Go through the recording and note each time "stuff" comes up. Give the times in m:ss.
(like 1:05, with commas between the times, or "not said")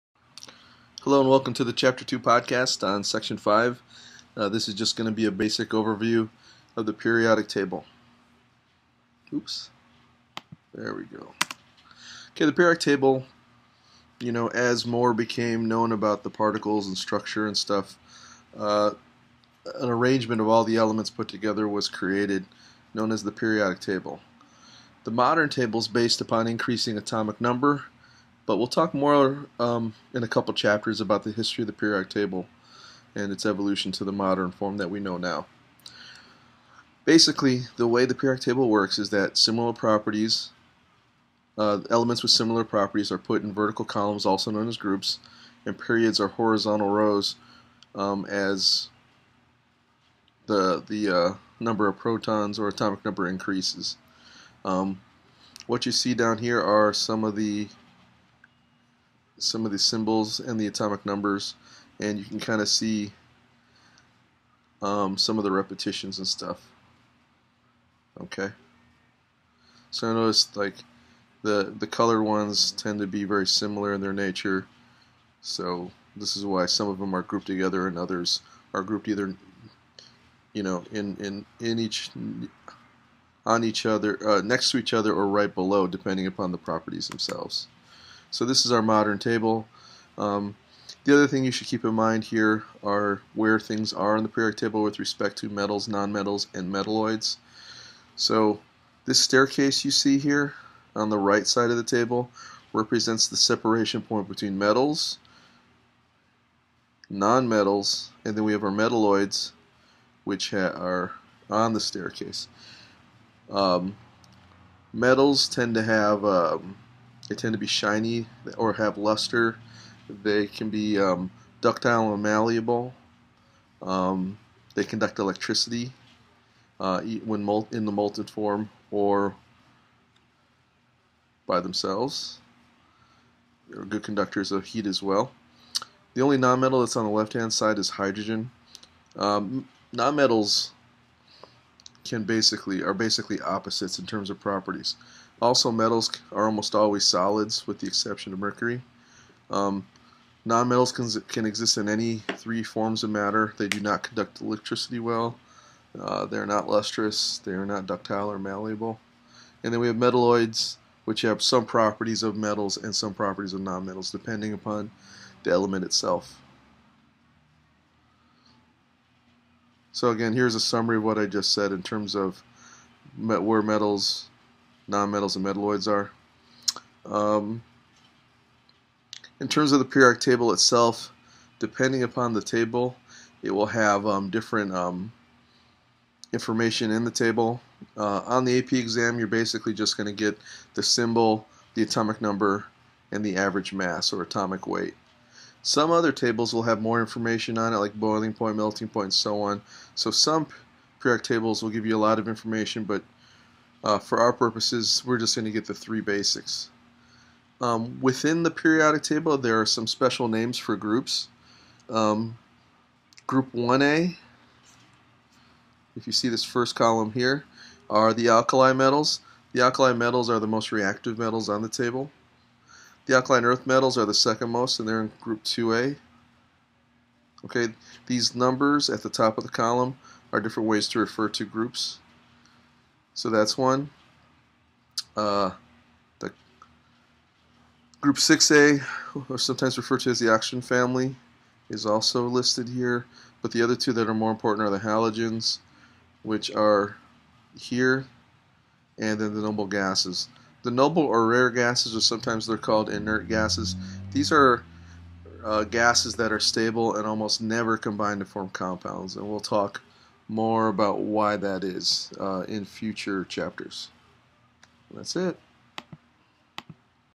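0:17, 1:06.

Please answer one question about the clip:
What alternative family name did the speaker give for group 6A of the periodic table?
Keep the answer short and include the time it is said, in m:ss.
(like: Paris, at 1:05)
Oxygen family, at 4:00.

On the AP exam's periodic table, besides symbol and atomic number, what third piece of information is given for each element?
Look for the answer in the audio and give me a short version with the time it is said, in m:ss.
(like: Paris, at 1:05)
Average mass or atomic weight, at 3:13.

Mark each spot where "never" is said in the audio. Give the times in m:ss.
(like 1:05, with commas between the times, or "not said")
4:17.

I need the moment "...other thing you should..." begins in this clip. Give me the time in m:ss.
1:31.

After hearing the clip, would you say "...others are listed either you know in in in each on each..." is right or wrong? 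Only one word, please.
wrong.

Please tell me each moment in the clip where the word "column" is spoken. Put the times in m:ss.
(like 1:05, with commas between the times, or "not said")
0:43, 3:36, 3:49.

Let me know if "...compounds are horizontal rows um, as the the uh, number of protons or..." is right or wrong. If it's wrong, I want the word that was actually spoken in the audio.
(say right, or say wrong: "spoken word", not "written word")
wrong: "periods", not "compounds".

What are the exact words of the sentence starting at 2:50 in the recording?
So again, here's a summary of what I just said in terms of met where metals, nonmetals, and metalloids are.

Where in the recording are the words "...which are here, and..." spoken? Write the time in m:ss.
4:06.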